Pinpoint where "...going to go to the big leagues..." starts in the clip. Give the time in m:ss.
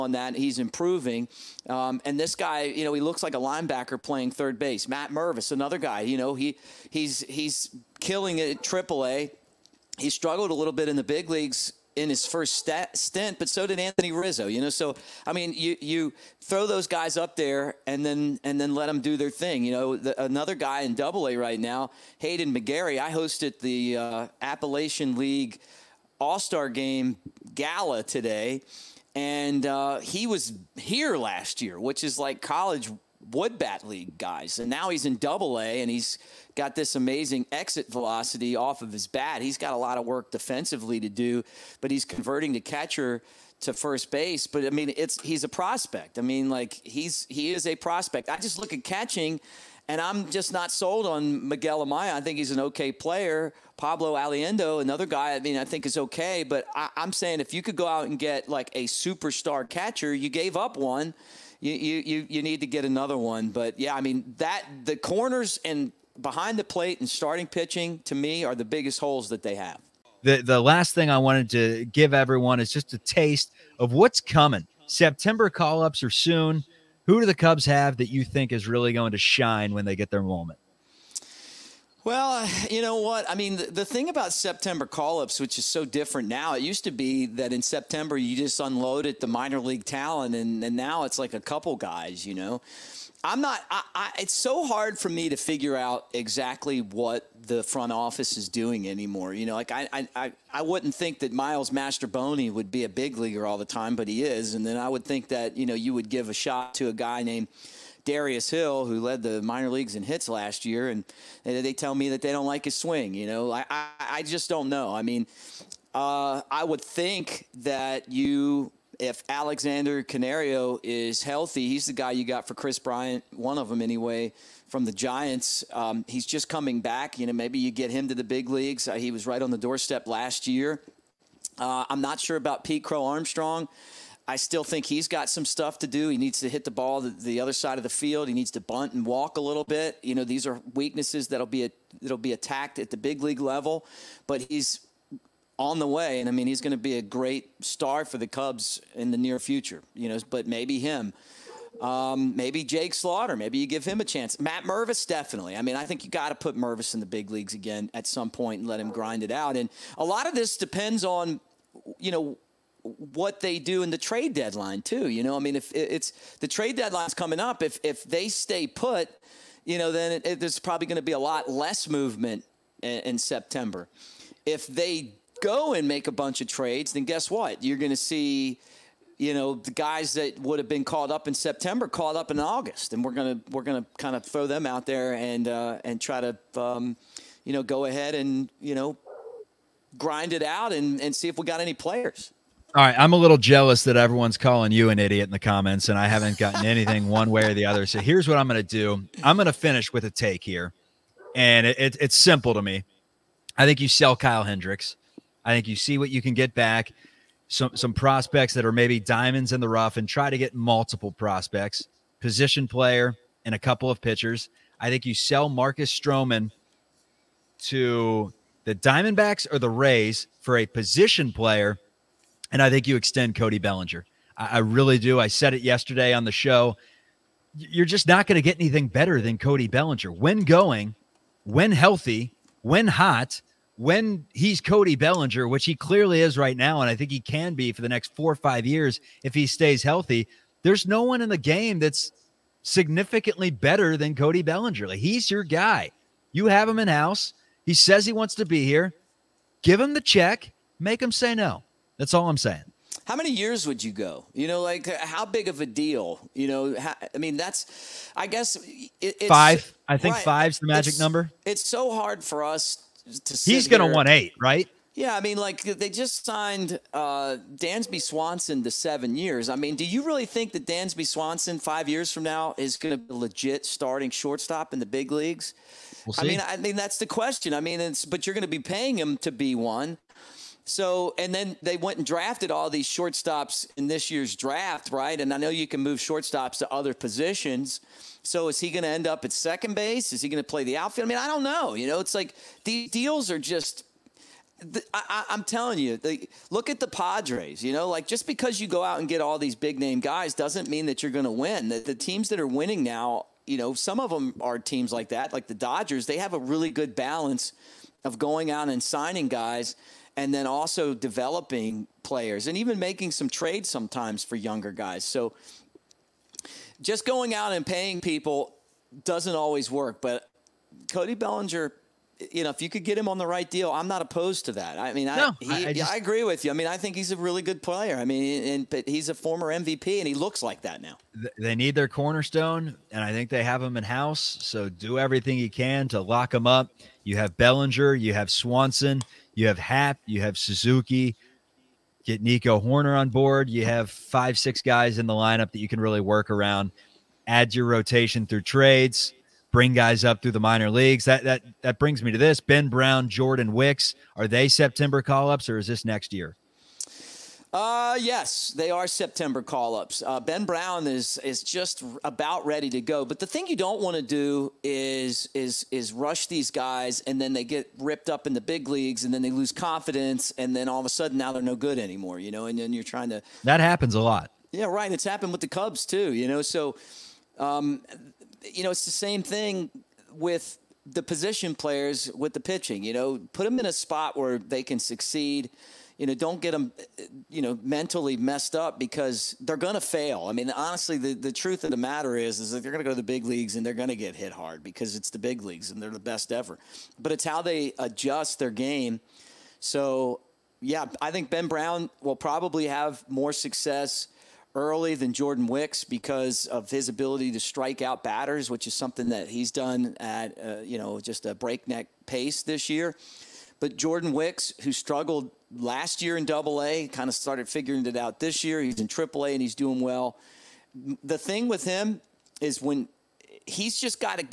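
6:32.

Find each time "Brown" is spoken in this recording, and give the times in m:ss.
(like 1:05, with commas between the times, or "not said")
5:52, 6:00, 6:41.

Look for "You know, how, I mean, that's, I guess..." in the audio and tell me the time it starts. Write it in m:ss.
4:16.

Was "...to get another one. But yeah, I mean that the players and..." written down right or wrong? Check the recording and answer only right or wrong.
wrong.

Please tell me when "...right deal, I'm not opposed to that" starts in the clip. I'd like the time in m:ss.
5:23.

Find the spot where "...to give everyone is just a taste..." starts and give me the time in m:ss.
1:11.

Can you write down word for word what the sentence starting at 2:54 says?
If they go and make a bunch of trades, then guess what?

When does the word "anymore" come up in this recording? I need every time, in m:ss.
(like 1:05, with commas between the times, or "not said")
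1:38, 6:11.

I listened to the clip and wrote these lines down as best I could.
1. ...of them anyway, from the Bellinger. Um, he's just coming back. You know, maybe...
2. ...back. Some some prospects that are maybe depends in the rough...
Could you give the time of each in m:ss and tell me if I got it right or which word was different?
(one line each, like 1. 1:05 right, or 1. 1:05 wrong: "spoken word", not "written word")
1. 2:03 wrong: "Giants", not "Bellinger"
2. 3:26 wrong: "diamonds", not "depends".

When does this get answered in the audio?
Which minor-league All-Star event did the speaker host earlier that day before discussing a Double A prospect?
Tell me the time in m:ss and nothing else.
0:24.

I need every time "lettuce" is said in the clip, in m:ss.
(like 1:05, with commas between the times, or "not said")
not said.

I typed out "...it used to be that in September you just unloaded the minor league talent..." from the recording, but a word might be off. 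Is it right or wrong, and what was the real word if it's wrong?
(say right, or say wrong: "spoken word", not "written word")
right.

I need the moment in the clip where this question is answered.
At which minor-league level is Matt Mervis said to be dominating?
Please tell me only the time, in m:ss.
0:08.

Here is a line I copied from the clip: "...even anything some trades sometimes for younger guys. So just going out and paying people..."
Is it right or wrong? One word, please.
wrong.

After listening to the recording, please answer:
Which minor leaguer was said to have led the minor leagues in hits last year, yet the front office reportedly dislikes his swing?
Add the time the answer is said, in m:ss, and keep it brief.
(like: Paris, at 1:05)
Darius Hill, at 1:48.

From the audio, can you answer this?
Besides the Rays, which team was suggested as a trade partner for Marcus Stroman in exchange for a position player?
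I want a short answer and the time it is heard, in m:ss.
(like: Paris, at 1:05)
Diamondbacks, at 3:38.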